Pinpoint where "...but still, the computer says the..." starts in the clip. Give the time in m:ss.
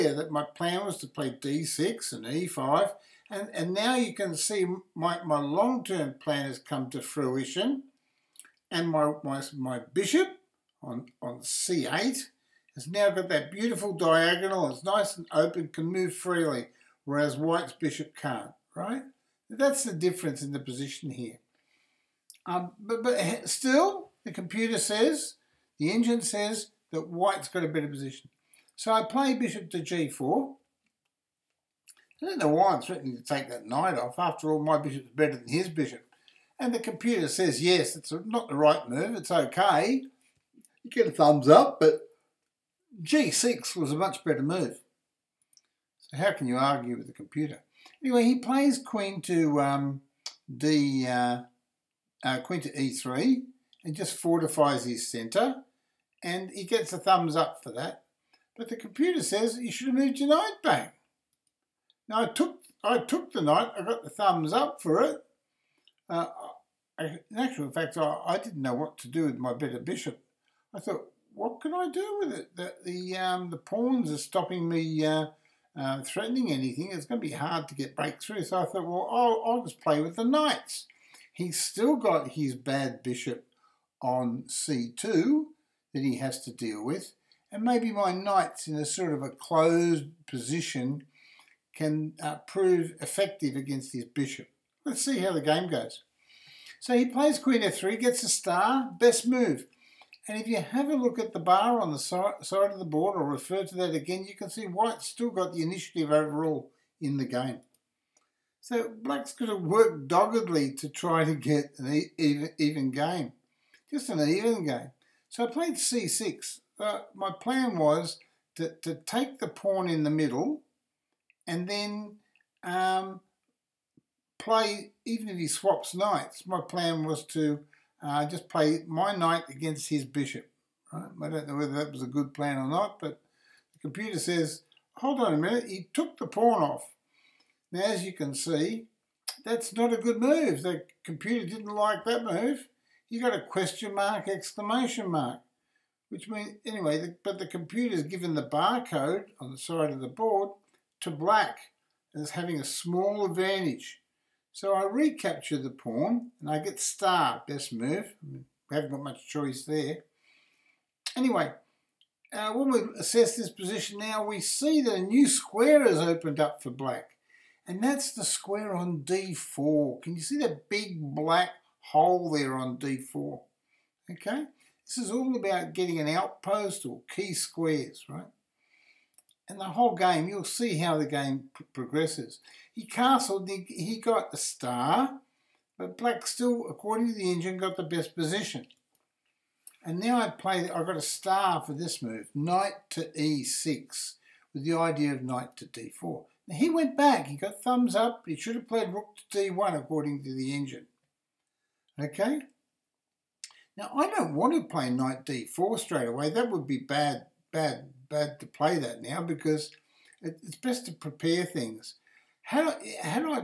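0:23.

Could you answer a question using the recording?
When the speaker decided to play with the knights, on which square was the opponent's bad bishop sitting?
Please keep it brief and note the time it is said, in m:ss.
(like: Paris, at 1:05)
c2, at 1:24.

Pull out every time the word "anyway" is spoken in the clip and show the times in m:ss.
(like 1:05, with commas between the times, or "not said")
0:48, 2:26, 2:41.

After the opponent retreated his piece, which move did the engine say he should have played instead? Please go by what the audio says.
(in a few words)
Rook to d1.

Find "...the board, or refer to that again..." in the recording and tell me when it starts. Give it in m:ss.
1:42.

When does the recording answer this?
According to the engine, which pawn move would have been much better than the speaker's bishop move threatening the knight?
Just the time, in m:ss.
0:43.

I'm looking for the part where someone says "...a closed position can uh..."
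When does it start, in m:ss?
1:29.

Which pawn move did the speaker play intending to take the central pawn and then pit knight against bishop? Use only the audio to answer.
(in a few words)
c6.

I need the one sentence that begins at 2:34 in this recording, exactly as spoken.
So I recapture the pawn and I get star, best move.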